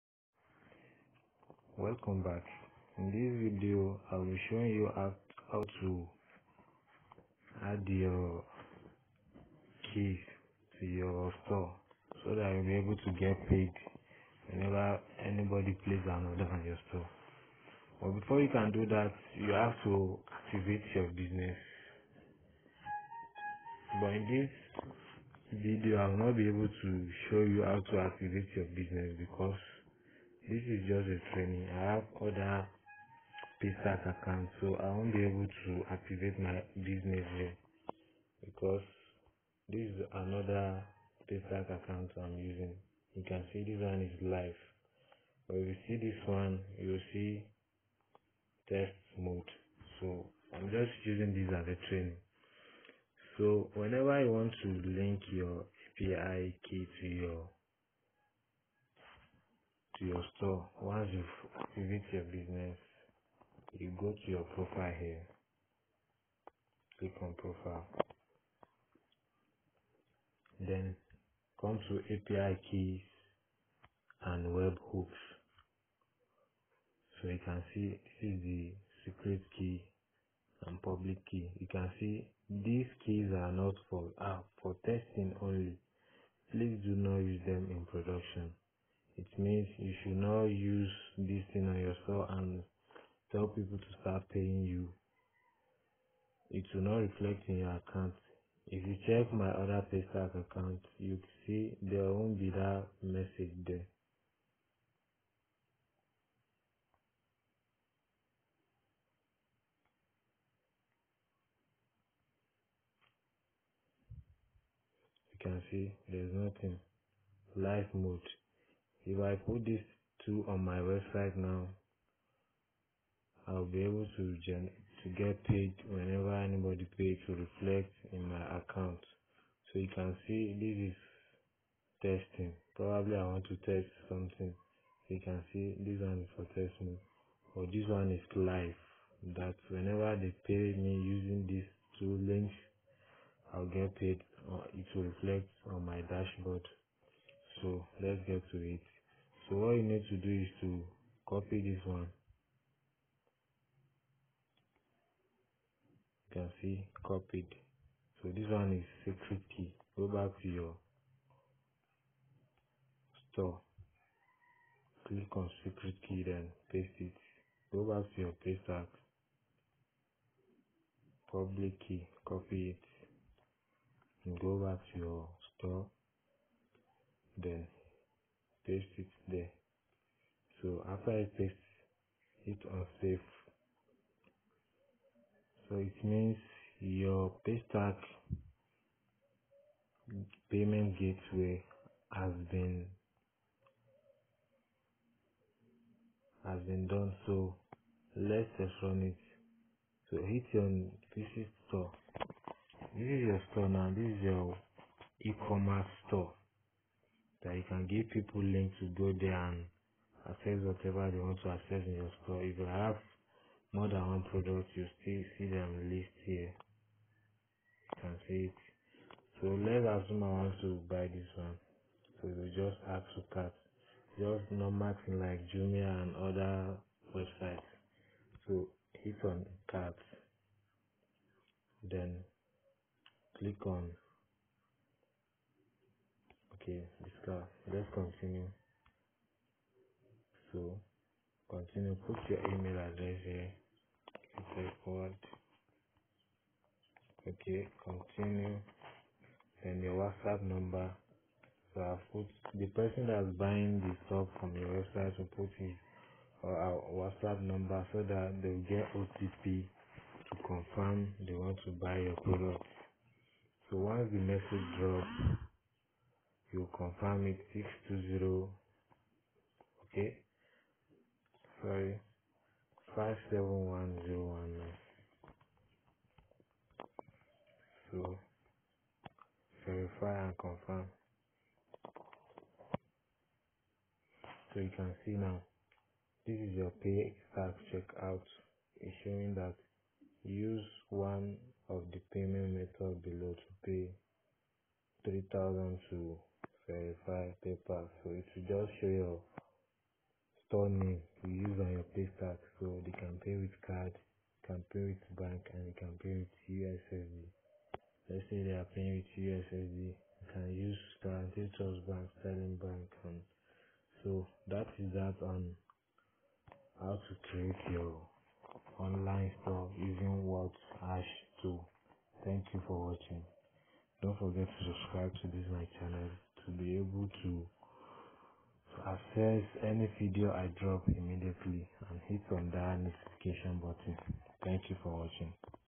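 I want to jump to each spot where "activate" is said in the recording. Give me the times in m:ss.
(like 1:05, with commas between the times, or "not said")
0:20, 0:27, 0:35.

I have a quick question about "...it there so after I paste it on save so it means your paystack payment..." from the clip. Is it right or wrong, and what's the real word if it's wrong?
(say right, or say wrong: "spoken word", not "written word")
right.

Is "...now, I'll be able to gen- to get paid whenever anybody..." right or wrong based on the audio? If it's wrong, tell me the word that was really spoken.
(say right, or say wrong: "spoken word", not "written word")
right.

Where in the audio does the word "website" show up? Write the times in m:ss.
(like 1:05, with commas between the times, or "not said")
2:00, 3:47, 4:14.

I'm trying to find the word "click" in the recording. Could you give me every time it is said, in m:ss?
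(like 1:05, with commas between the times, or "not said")
1:06, 2:45, 3:53.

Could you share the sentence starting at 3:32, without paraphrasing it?
If you have more than one product, you still see them list here.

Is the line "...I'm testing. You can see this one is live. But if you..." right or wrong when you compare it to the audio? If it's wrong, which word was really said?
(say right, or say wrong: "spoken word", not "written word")
wrong: "using", not "testing".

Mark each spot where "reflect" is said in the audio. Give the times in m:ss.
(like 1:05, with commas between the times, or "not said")
1:36, 2:07, 2:25.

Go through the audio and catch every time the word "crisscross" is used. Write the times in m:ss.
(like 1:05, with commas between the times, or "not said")
not said.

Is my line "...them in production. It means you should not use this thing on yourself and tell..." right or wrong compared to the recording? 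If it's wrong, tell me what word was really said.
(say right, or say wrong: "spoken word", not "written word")
right.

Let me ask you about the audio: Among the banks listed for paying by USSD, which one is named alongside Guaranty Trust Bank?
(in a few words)
Sterling Bank.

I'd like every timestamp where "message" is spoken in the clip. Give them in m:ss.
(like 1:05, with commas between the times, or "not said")
1:43, 4:24.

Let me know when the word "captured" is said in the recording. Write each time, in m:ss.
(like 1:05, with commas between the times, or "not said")
not said.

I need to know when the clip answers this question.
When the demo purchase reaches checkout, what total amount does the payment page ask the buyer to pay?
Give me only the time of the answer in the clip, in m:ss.
4:55.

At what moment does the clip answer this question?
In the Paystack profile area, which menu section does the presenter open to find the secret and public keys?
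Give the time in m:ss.
1:12.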